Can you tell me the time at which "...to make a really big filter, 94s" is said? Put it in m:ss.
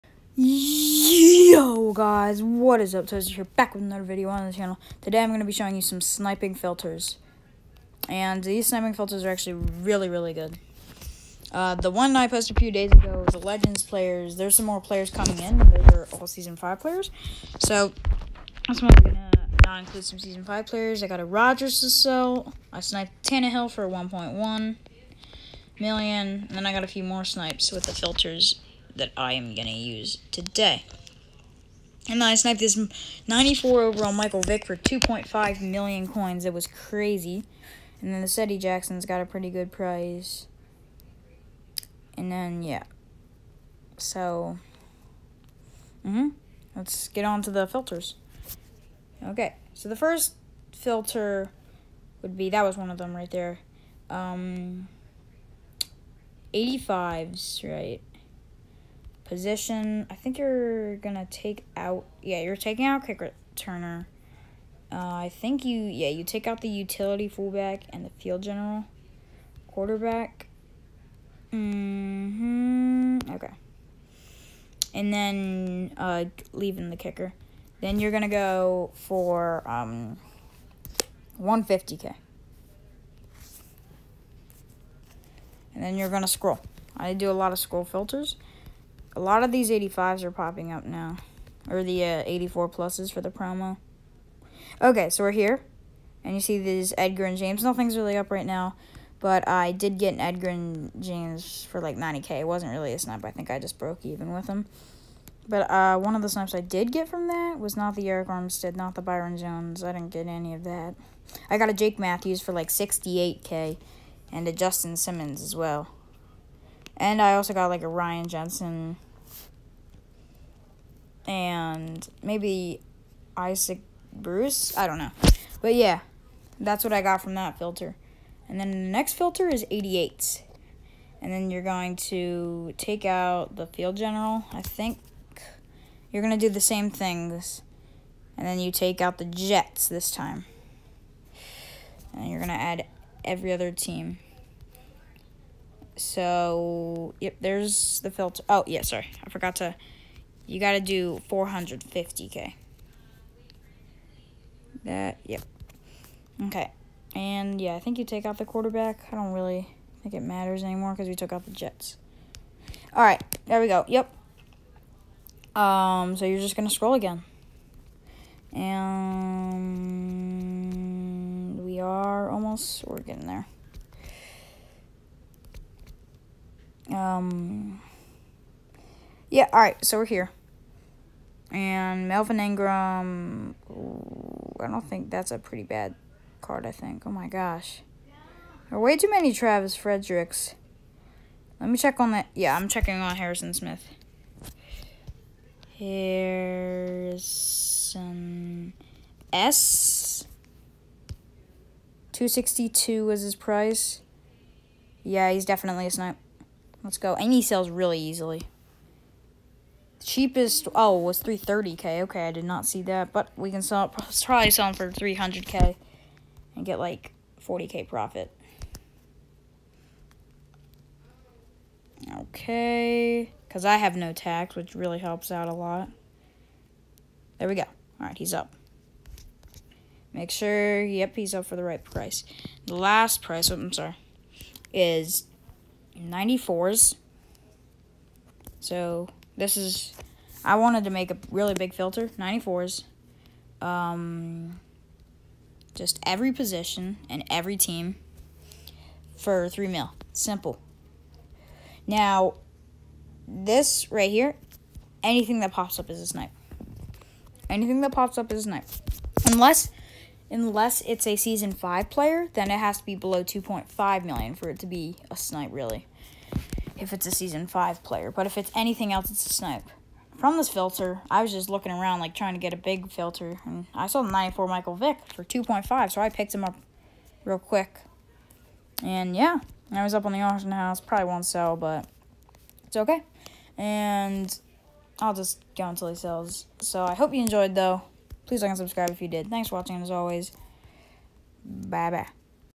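4:00.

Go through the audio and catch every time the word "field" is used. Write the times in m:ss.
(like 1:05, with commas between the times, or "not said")
1:08, 2:13.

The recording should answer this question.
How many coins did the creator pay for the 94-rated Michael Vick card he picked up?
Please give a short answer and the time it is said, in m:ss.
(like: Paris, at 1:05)
2.5 million, at 0:34.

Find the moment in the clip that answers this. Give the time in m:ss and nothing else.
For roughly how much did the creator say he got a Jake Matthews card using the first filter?
1:52.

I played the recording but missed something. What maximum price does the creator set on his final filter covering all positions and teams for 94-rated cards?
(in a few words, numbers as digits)
3 mil.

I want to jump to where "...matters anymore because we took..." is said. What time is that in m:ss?
2:40.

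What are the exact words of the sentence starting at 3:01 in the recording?
And Melvin Ingram, ooh, I don't think that's a pretty bad card, I think.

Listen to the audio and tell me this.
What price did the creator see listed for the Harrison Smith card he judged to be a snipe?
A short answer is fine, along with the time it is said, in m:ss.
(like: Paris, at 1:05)
262, at 3:22.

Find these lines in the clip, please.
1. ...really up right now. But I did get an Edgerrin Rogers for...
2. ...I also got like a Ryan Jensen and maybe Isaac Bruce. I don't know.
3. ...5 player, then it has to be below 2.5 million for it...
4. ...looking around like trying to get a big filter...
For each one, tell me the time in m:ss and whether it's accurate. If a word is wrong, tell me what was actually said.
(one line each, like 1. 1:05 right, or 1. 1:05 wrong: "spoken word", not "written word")
1. 1:37 wrong: "James", not "Rogers"
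2. 1:57 right
3. 4:21 right
4. 4:31 right.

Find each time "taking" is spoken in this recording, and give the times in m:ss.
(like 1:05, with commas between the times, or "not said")
1:02.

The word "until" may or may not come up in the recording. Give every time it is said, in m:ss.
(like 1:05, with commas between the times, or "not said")
4:45.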